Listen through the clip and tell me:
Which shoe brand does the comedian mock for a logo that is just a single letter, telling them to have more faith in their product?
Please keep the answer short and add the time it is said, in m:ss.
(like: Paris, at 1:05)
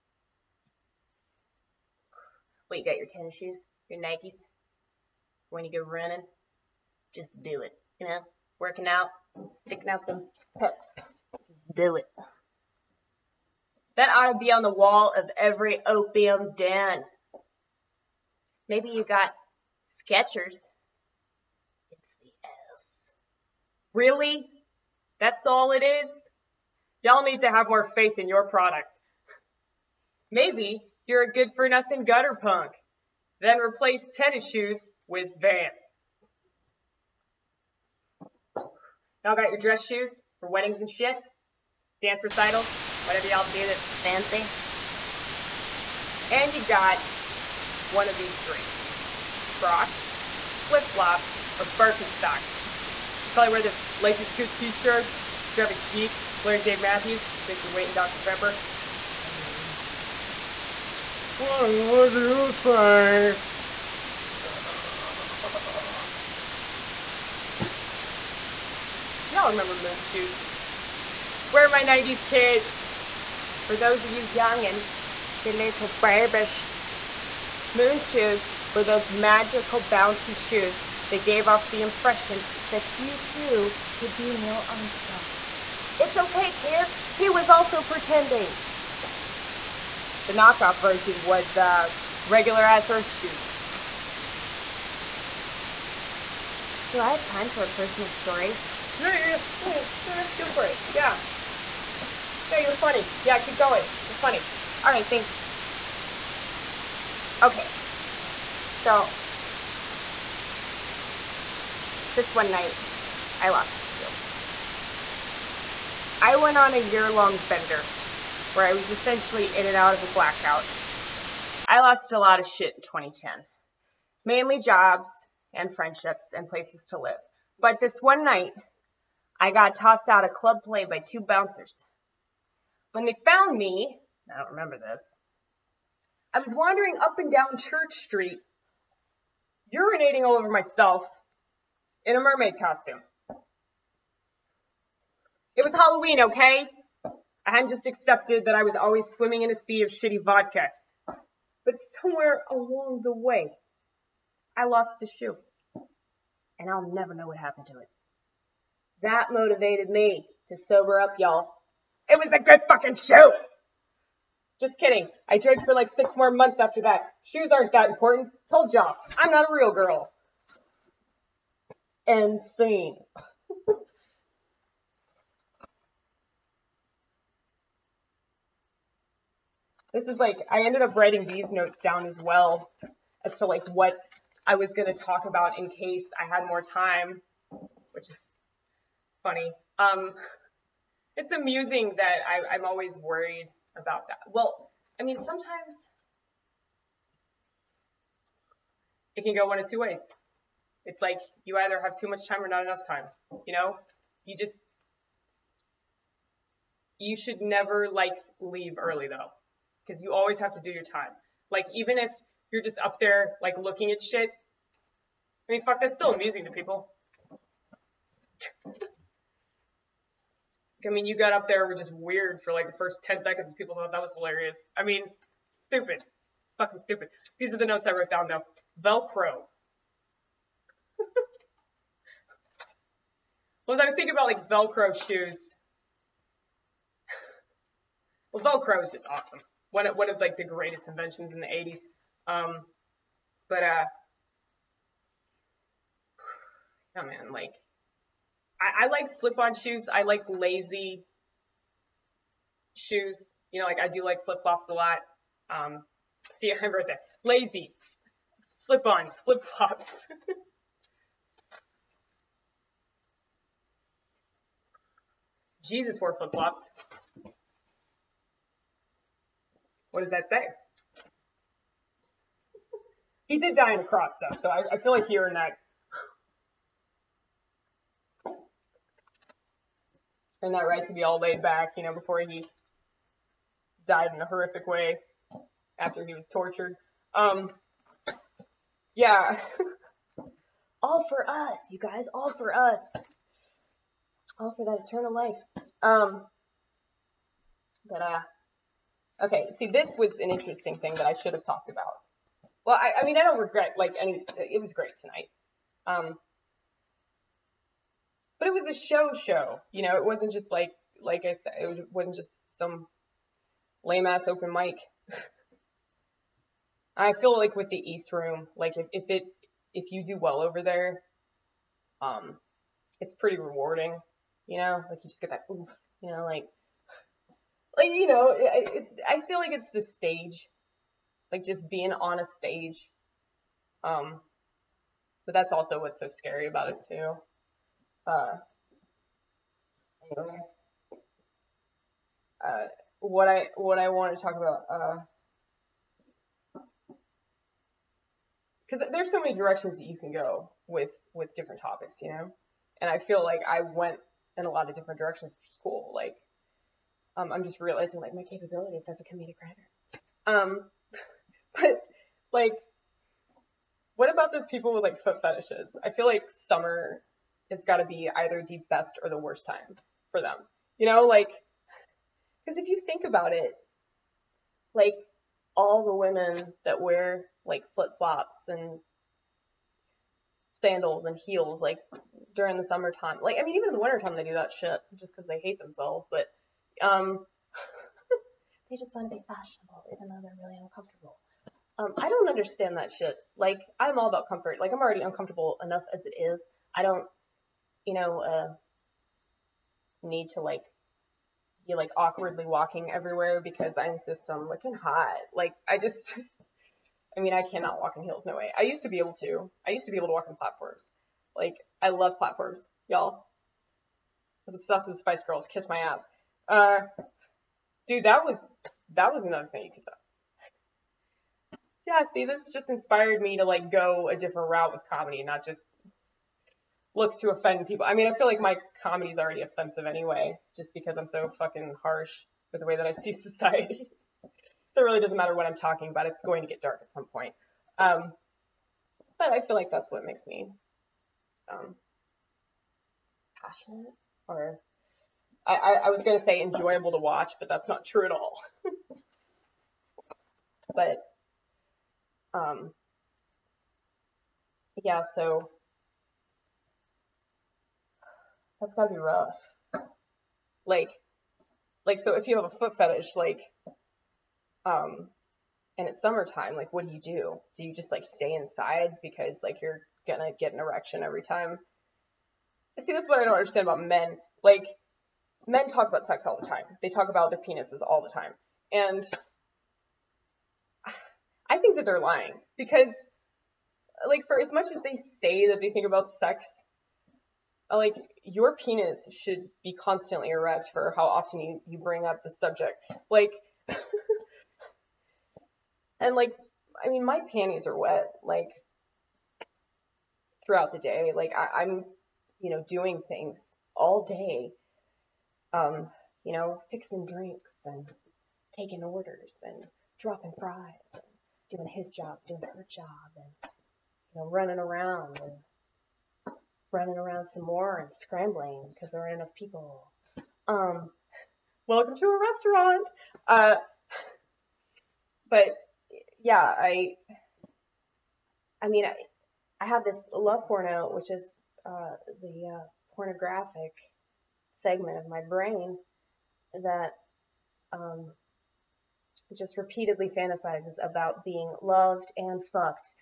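Skechers, at 0:20.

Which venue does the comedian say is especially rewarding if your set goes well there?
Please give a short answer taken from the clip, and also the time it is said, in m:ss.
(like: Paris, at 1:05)
East Room, at 5:17.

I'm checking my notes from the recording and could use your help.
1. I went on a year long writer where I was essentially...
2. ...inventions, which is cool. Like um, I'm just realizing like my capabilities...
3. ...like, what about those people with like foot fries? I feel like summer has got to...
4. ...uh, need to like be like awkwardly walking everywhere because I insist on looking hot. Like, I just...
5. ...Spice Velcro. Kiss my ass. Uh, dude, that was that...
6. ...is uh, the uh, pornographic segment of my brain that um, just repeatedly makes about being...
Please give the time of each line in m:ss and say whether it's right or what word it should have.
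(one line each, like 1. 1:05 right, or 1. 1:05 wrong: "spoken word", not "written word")
1. 1:56 wrong: "bender", not "writer"
2. 5:54 wrong: "directions", not "inventions"
3. 6:02 wrong: "fetishes", not "fries"
4. 6:38 right
5. 6:54 wrong: "Girls", not "Velcro"
6. 8:51 wrong: "fantasizes", not "makes".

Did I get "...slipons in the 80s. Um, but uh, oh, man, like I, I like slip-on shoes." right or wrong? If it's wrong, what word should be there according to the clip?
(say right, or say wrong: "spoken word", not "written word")
wrong: "inventions", not "slipons".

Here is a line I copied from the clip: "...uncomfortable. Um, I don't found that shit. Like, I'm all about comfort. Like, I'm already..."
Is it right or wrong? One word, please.
wrong.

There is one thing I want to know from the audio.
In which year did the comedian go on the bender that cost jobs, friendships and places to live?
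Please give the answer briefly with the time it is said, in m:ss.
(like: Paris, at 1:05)
2010, at 2:02.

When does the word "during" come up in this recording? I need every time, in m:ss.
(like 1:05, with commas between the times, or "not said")
6:22.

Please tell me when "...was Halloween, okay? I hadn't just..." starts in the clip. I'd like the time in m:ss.
2:25.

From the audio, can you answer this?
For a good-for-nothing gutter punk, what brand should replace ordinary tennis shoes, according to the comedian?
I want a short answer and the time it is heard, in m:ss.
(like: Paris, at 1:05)
Vans, at 0:35.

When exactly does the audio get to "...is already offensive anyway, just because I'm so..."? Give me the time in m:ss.
7:09.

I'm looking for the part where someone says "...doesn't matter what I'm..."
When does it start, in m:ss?
7:14.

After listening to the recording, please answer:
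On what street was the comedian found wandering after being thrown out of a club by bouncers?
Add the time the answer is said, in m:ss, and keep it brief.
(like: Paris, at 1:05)
Church Street, at 2:17.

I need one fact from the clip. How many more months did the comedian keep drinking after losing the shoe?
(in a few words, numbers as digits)
6.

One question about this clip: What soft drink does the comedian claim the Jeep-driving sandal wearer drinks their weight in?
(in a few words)
Dr. Pepper.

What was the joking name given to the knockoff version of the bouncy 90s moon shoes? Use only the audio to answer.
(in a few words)
regular ass earth shoes.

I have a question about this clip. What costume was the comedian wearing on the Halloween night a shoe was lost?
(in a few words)
mermaid costume.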